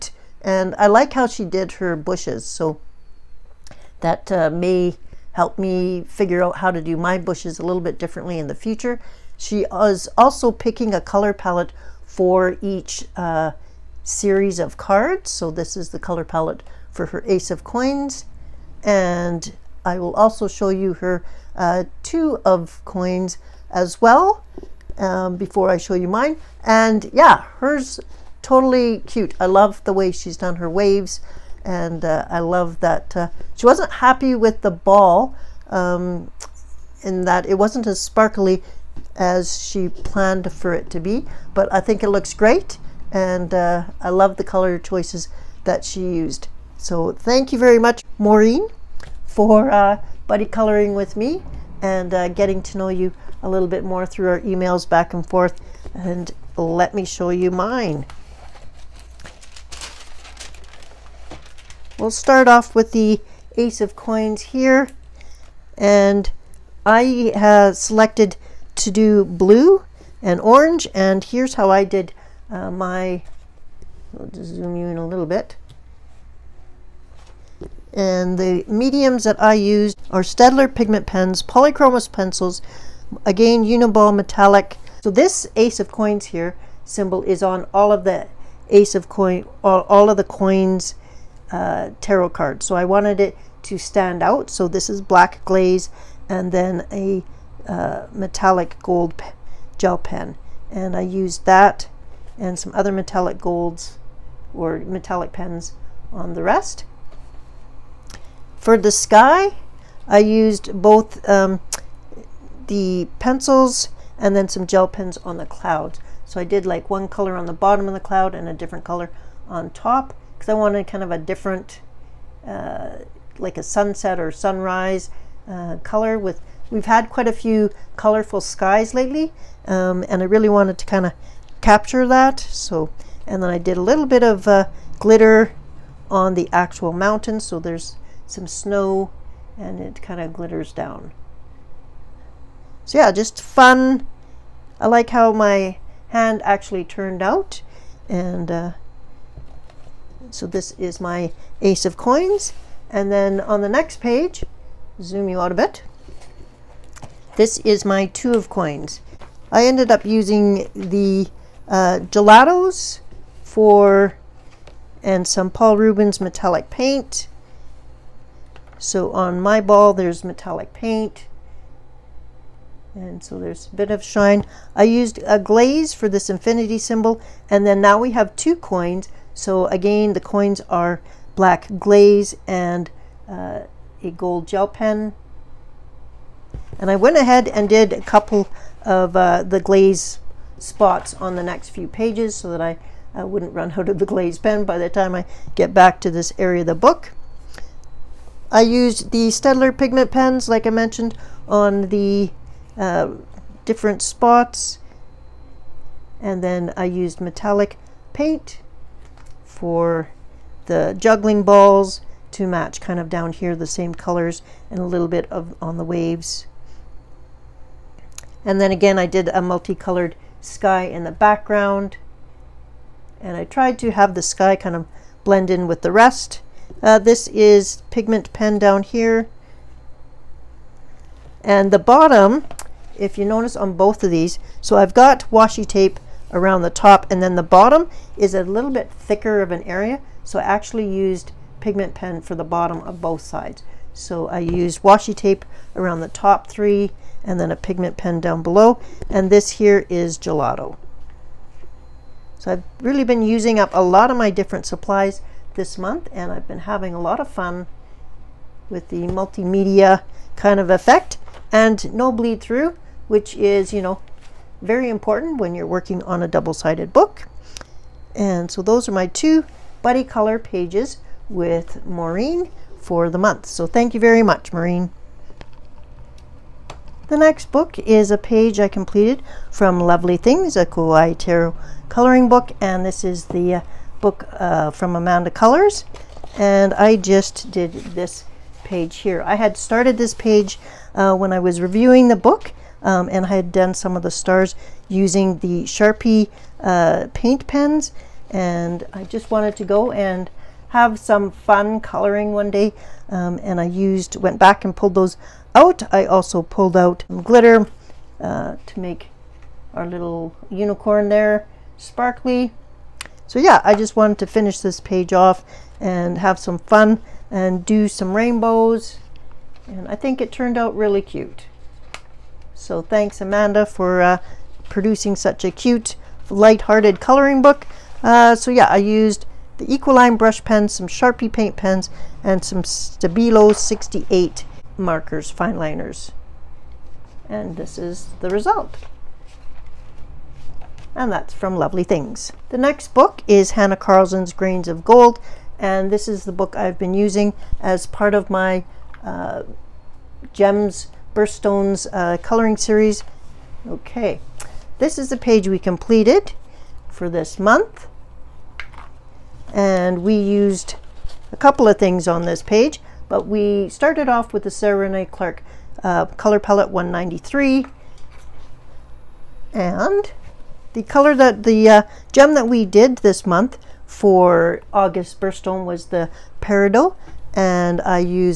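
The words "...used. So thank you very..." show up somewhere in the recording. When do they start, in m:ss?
0:46.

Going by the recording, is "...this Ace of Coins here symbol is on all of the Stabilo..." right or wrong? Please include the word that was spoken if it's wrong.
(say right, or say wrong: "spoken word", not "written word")
wrong: "Ace", not "Stabilo".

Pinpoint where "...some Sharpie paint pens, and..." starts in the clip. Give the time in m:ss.
5:30.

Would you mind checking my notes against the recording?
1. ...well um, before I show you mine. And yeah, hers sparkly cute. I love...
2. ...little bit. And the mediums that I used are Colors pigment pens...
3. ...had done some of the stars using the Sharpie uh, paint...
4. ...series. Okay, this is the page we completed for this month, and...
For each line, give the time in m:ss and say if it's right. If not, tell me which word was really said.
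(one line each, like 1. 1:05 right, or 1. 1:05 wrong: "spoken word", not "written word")
1. 0:24 wrong: "totally", not "sparkly"
2. 1:15 wrong: "Staedtler", not "Colors"
3. 4:53 right
4. 5:52 right.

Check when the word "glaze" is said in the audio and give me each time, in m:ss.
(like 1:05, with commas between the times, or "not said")
1:35, 2:55, 3:01, 3:09, 3:14.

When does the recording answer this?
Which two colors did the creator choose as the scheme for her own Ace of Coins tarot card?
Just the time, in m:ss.
1:09.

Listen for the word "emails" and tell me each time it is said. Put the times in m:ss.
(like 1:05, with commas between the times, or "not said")
0:54.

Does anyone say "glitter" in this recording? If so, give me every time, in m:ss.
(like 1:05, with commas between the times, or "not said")
2:14, 2:20, 5:07.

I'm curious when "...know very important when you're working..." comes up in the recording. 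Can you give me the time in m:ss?
4:23.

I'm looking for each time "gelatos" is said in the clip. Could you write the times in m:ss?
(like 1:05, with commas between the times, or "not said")
2:42, 4:10.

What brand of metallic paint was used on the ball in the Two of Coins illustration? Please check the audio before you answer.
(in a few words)
Paul Rubens.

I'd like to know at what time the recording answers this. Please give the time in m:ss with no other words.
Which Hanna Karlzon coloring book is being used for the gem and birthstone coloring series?
5:44.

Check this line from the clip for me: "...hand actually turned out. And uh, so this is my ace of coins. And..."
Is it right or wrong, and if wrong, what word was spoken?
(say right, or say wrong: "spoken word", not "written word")
right.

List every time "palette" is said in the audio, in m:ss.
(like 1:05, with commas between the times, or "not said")
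0:11, 0:16, 6:06.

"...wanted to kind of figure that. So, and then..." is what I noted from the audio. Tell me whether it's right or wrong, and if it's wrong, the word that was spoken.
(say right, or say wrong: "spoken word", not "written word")
wrong: "capture", not "figure".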